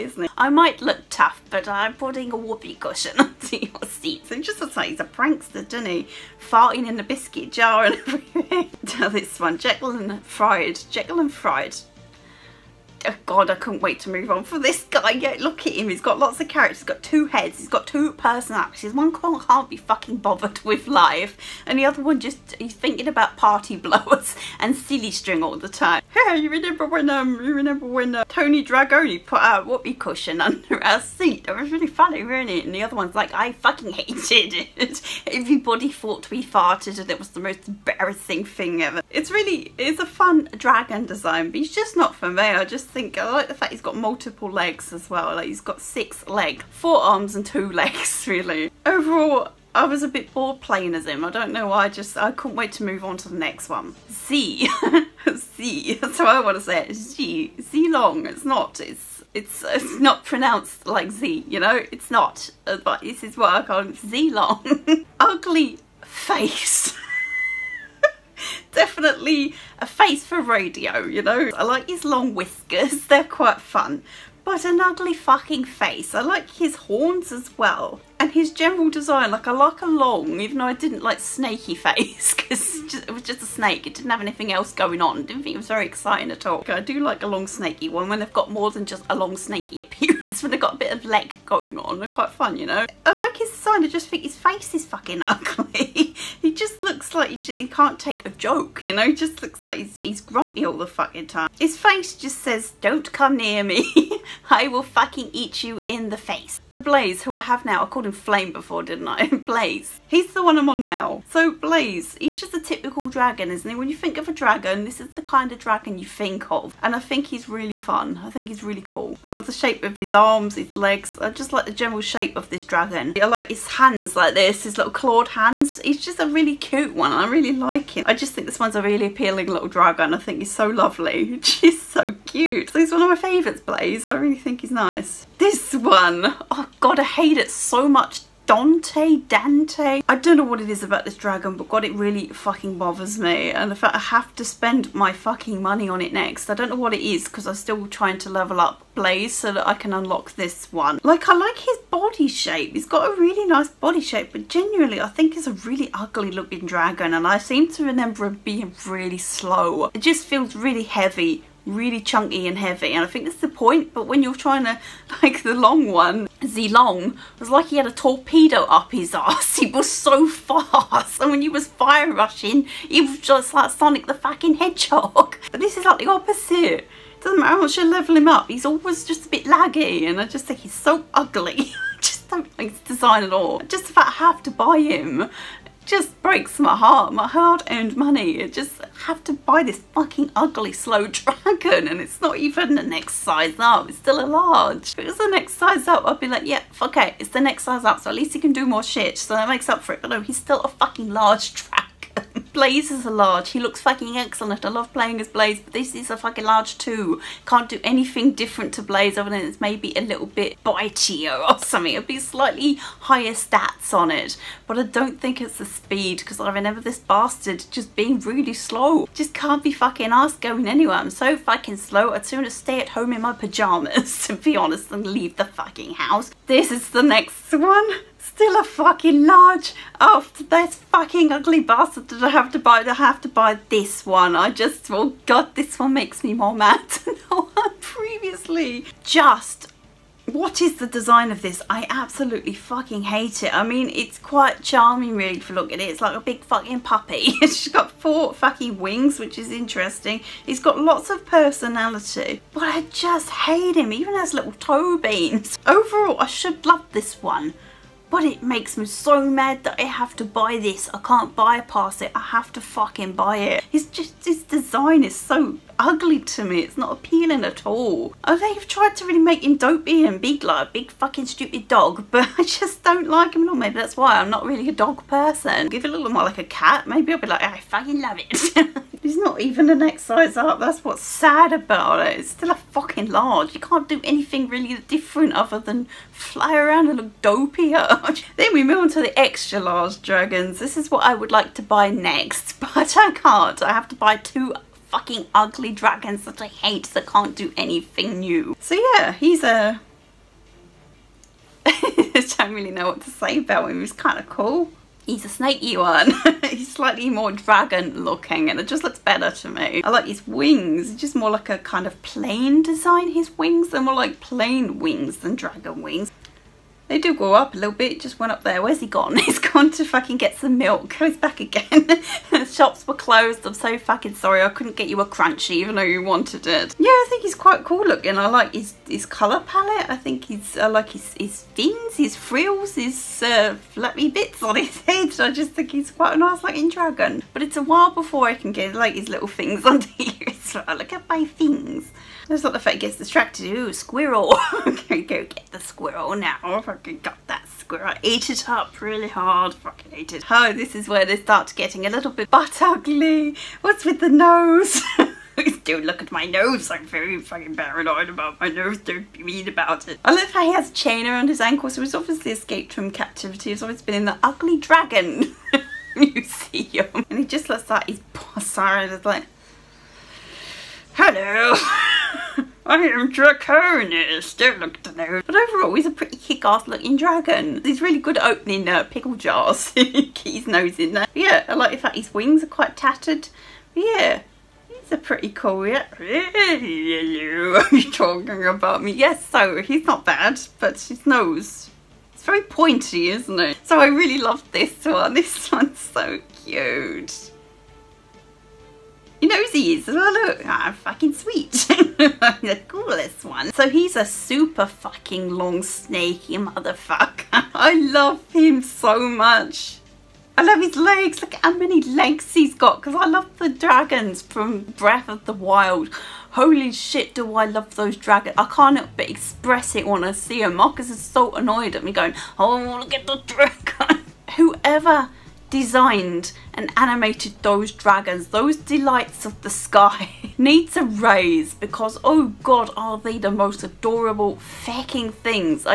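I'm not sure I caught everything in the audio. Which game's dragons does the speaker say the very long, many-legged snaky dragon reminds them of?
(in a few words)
Breath of the Wild.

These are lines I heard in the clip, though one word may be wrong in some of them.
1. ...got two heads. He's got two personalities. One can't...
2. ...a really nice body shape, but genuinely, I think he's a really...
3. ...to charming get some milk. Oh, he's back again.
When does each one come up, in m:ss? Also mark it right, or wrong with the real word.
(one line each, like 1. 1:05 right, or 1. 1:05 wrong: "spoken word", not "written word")
1. 0:16 right
2. 2:33 right
3. 5:19 wrong: "fucking", not "charming".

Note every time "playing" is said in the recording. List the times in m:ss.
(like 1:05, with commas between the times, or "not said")
0:50, 3:24.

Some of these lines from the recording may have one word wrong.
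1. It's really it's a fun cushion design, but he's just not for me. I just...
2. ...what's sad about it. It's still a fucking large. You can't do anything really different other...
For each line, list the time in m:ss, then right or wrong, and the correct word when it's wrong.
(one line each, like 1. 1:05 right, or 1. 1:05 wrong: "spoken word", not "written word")
1. 0:39 wrong: "dragon", not "cushion"
2. 4:40 right.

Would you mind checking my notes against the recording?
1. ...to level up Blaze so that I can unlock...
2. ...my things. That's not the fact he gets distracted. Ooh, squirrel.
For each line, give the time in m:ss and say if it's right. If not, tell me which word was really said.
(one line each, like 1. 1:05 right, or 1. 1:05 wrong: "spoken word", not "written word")
1. 2:28 right
2. 5:41 right.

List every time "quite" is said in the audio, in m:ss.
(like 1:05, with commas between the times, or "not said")
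1:13, 1:32, 4:04, 5:27, 5:35, 6:22.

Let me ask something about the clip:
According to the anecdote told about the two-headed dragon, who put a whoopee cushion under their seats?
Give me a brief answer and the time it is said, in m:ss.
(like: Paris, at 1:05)
Tony Dragoni, at 0:28.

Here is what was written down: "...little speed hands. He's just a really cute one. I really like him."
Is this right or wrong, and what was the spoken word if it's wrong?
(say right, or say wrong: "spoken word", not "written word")
wrong: "clawed", not "speed".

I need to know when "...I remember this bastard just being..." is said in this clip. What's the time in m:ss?
3:36.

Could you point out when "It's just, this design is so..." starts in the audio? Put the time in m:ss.
4:23.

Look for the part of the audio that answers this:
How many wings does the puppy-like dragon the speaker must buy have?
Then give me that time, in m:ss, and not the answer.
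4:07.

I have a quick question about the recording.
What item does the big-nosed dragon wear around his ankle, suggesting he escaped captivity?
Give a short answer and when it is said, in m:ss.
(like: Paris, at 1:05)
A chain, at 6:00.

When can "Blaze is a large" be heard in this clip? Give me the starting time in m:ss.
3:22.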